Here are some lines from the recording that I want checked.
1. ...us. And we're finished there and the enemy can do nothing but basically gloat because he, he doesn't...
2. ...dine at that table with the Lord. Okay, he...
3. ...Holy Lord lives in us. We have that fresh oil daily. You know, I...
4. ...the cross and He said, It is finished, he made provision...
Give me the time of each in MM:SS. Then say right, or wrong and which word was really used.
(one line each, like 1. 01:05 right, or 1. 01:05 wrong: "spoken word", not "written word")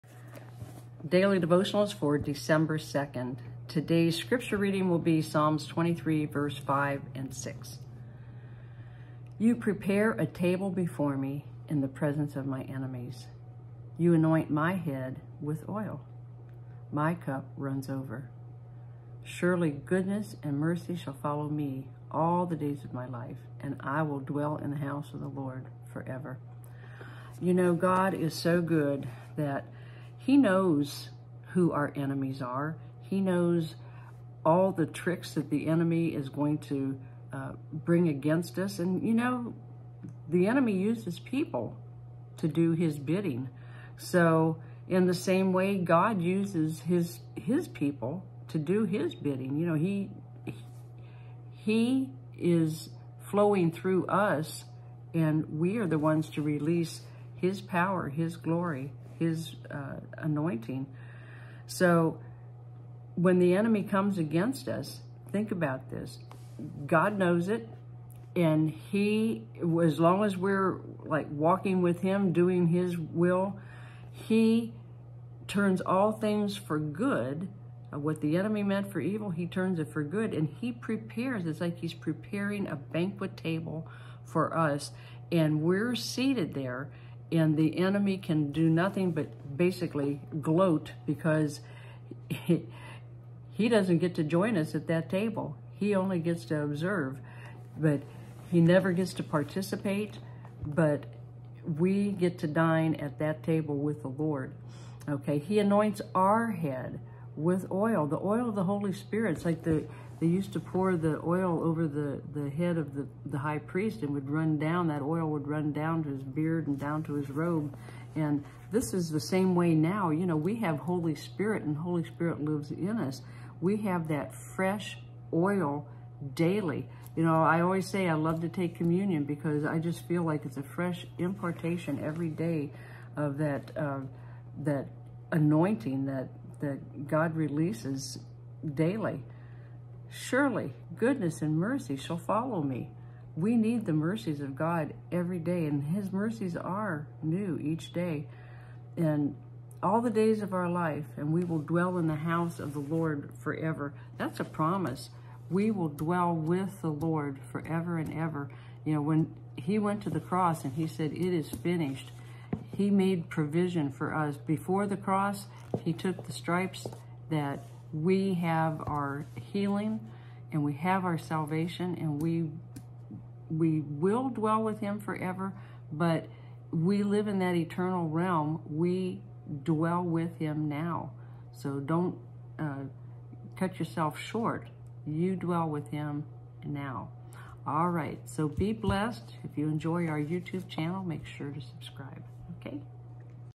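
1. 01:24 wrong: "seated", not "finished"
2. 01:42 right
3. 02:01 wrong: "Spirit", not "Lord"
4. 02:40 right.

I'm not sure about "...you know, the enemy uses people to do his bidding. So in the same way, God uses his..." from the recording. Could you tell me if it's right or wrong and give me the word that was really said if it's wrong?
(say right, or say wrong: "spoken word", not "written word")
right.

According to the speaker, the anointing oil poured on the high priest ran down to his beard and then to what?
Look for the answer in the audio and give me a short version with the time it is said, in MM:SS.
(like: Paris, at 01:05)
His robe, at 01:57.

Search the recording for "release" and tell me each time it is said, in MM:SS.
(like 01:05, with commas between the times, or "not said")
00:56, 02:17.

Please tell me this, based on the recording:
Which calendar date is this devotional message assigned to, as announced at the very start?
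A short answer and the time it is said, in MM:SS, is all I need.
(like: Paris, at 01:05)
December 2nd, at 00:02.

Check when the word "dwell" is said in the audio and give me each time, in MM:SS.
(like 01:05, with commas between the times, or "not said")
00:24, 02:31, 02:35, 02:54, 02:59, 03:05.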